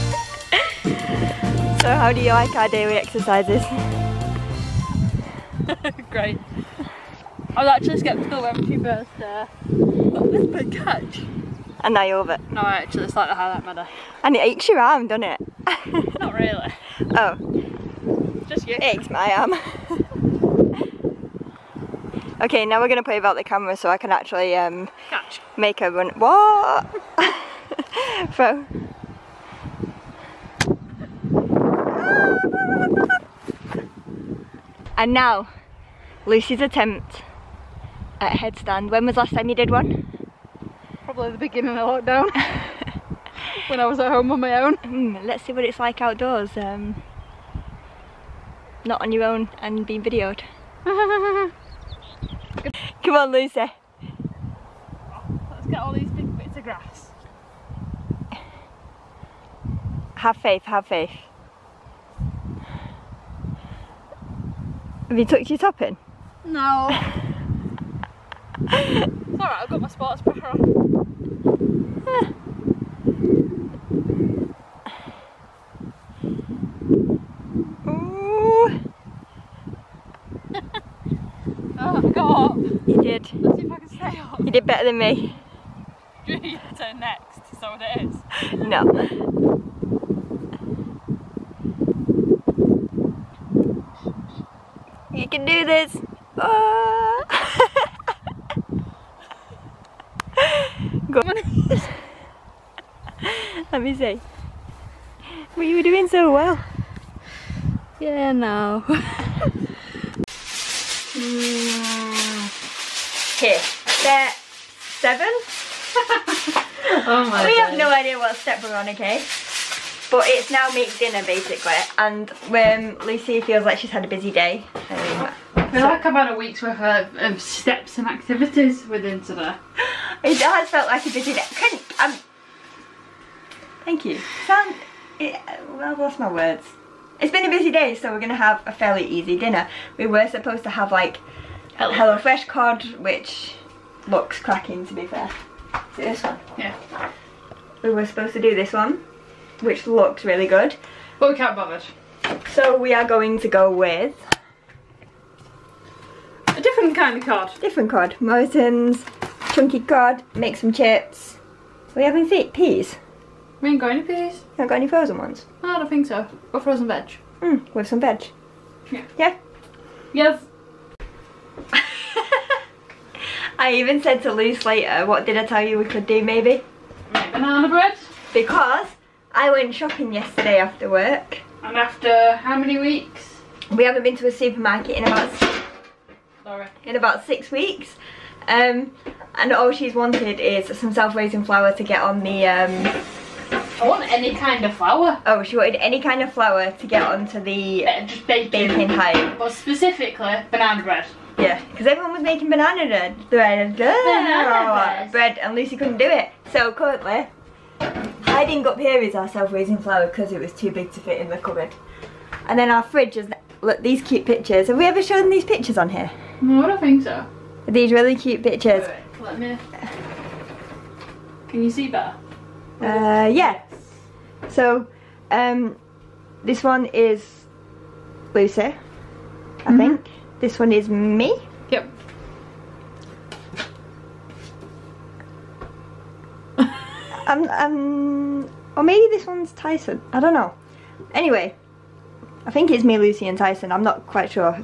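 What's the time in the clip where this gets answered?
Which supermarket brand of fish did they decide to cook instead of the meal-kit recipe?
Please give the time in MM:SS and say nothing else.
02:38.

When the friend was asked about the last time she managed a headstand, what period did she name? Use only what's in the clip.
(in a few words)
beginning of lockdown.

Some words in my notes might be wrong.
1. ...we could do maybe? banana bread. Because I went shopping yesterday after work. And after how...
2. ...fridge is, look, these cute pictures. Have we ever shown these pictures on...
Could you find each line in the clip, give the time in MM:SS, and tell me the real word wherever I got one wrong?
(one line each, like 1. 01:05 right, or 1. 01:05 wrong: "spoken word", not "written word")
1. 02:55 right
2. 03:32 right.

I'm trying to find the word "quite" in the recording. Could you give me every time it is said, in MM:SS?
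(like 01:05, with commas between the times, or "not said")
04:04.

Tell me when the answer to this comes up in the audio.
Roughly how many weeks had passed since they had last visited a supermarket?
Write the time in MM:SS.
03:07.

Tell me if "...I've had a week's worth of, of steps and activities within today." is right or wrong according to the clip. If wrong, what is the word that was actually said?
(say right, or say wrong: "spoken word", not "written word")
right.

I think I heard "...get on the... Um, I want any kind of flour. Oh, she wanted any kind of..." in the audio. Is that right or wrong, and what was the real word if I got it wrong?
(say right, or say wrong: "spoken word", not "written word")
right.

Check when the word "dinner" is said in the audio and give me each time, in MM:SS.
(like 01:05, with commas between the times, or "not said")
02:00, 02:19.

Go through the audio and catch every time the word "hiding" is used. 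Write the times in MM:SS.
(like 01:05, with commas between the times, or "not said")
03:28.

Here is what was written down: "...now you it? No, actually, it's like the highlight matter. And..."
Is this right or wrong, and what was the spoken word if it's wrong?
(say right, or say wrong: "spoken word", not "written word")
right.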